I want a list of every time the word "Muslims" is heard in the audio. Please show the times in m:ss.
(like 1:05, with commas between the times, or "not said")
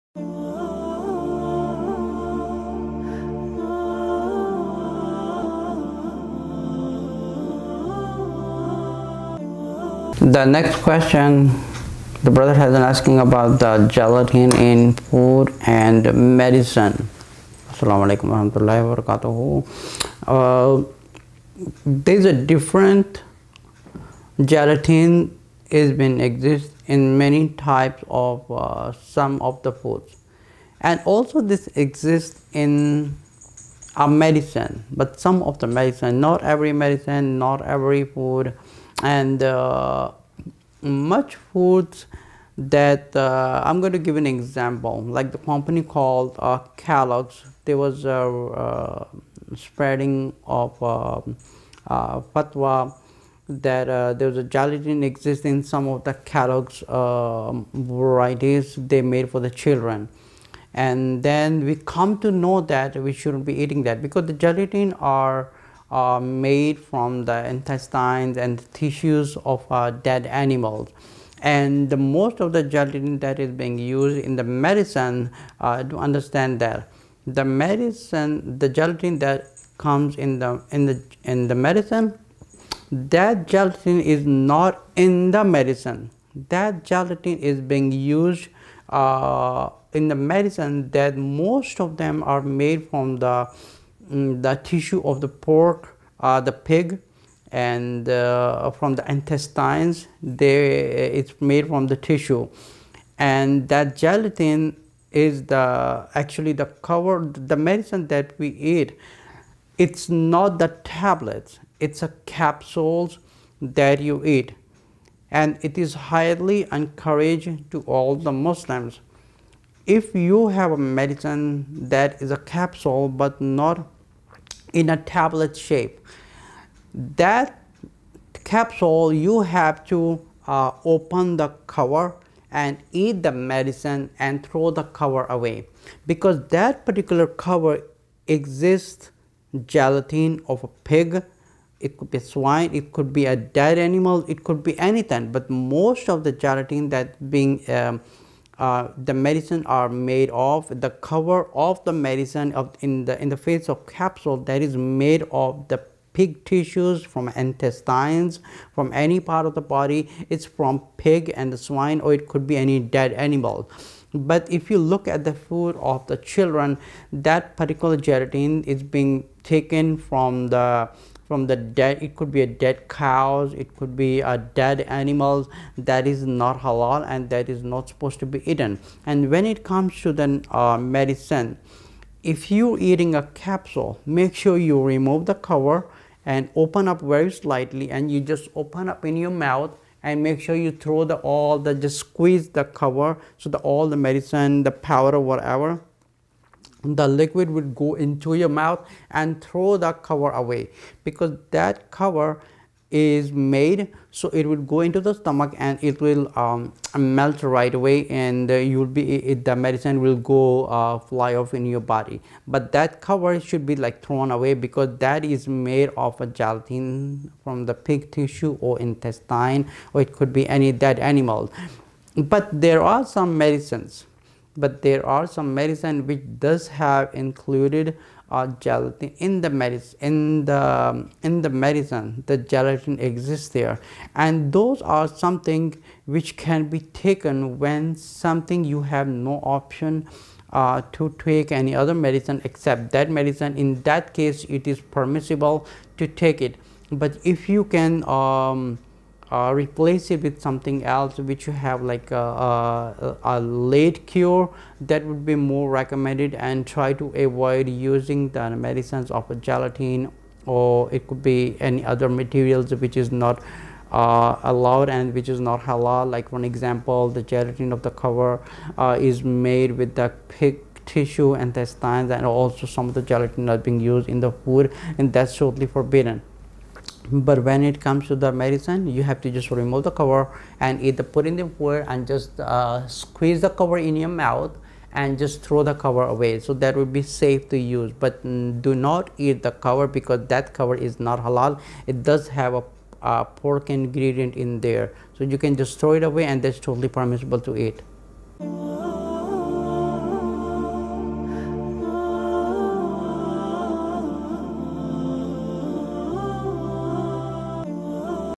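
1:58.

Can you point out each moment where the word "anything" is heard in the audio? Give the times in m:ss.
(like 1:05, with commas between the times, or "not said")
2:24.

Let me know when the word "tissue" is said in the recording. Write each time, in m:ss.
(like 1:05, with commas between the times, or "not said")
1:08, 1:34, 1:41, 2:36, 3:38, 4:30.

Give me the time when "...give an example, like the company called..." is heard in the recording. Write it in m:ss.
0:43.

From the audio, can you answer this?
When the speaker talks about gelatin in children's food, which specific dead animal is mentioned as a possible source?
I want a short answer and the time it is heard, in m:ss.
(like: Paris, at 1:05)
dead cows, at 2:52.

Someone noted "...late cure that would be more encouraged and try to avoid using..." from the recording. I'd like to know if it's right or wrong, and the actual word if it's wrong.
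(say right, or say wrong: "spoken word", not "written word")
wrong: "recommended", not "encouraged".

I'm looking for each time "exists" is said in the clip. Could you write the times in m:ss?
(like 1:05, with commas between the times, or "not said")
0:26, 0:31, 0:55, 2:18, 3:52.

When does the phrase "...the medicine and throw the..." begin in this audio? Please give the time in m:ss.
2:13.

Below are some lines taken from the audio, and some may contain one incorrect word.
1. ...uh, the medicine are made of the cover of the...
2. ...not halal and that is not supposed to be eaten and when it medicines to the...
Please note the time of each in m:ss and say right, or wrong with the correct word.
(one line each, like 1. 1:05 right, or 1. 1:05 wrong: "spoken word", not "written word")
1. 2:28 right
2. 2:56 wrong: "comes", not "medicines".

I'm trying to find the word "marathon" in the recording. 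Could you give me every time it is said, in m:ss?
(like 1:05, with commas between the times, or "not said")
not said.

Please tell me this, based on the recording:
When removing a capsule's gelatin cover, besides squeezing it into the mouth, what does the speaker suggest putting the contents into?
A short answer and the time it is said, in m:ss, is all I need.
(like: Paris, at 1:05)
water, at 4:41.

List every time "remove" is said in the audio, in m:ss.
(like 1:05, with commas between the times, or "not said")
3:04, 4:39.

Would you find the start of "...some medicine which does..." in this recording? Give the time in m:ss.
3:45.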